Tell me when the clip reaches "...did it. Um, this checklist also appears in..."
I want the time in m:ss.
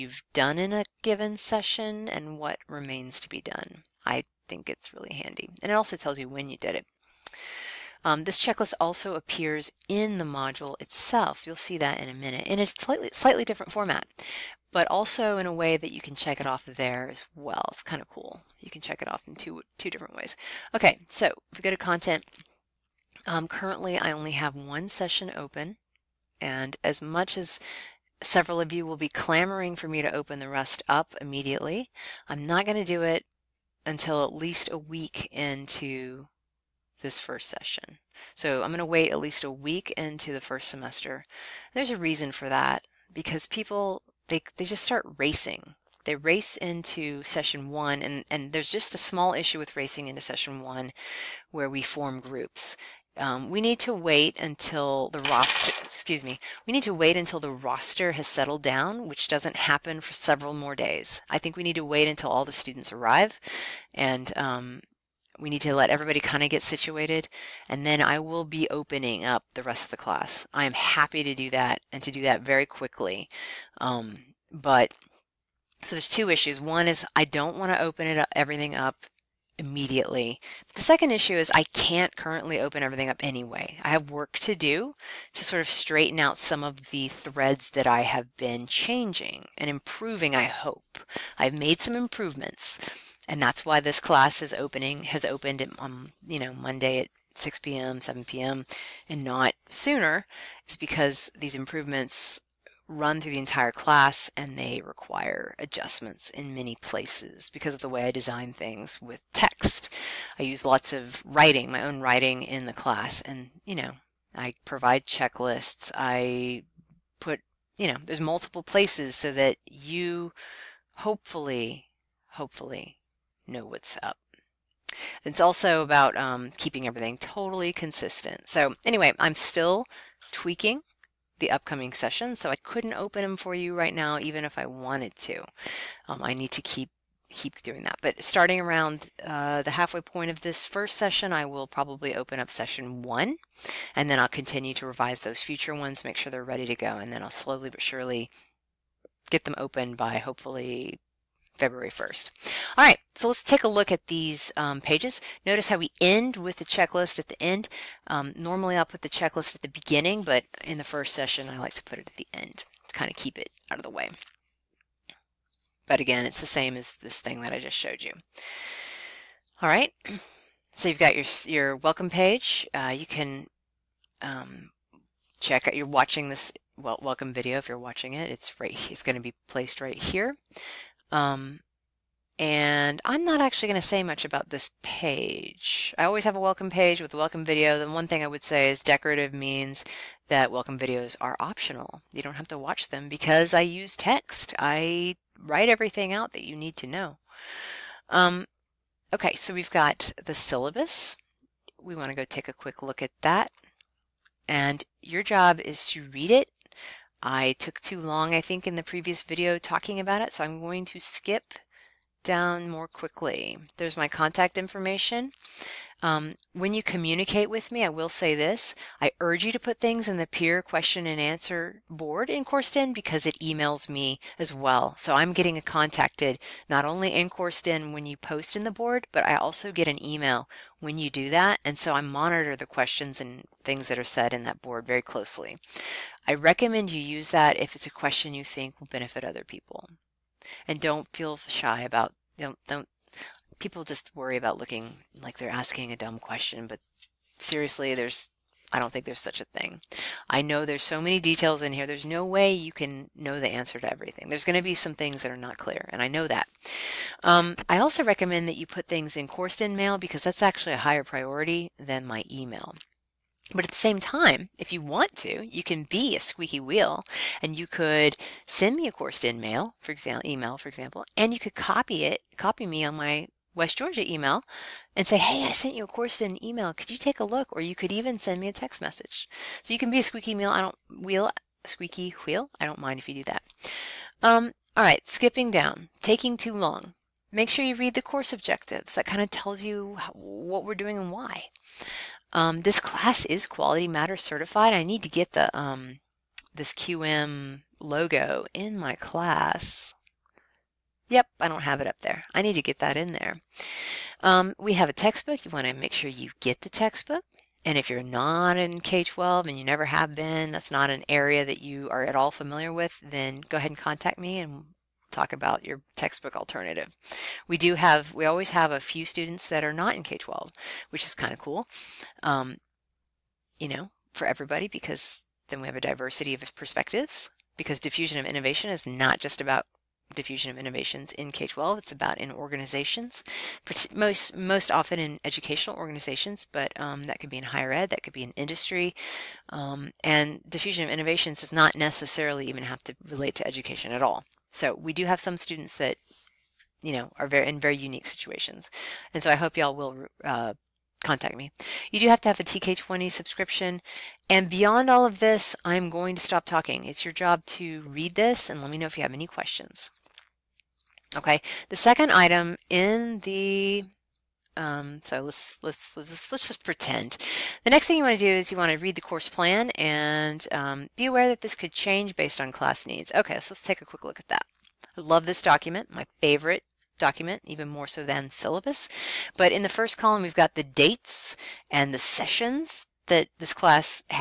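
0:06.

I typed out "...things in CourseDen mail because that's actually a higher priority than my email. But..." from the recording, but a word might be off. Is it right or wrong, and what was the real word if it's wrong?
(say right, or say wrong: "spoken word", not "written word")
right.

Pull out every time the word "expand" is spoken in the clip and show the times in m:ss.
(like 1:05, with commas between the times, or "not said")
not said.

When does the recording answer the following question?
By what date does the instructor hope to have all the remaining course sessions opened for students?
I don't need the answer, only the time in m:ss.
2:31.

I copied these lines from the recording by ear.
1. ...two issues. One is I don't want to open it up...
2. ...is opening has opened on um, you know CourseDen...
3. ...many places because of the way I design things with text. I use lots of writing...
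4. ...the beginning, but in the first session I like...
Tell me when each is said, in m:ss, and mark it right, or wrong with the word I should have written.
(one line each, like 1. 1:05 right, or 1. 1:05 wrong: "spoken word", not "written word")
1. 1:16 right
2. 1:34 wrong: "Monday", not "CourseDen"
3. 1:46 right
4. 2:39 right.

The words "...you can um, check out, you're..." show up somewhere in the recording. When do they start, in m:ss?
2:52.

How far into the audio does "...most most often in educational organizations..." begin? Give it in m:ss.
5:33.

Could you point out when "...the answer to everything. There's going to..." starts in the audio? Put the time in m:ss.
4:13.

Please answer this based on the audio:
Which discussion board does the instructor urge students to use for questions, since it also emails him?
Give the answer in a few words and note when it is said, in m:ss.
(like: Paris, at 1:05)
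Peer question and answer board, at 3:40.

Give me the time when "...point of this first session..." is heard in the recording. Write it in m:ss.
2:20.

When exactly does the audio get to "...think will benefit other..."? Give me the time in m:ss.
3:58.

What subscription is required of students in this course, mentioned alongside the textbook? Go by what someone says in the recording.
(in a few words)
TK20.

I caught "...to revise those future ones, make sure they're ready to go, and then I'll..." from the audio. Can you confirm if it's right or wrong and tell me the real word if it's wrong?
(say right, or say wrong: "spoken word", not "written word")
right.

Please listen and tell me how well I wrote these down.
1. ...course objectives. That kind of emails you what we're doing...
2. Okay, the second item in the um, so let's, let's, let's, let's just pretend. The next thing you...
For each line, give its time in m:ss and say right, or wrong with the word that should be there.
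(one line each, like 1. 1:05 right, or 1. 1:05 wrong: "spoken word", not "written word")
1. 4:48 wrong: "tells", not "emails"
2. 6:01 right.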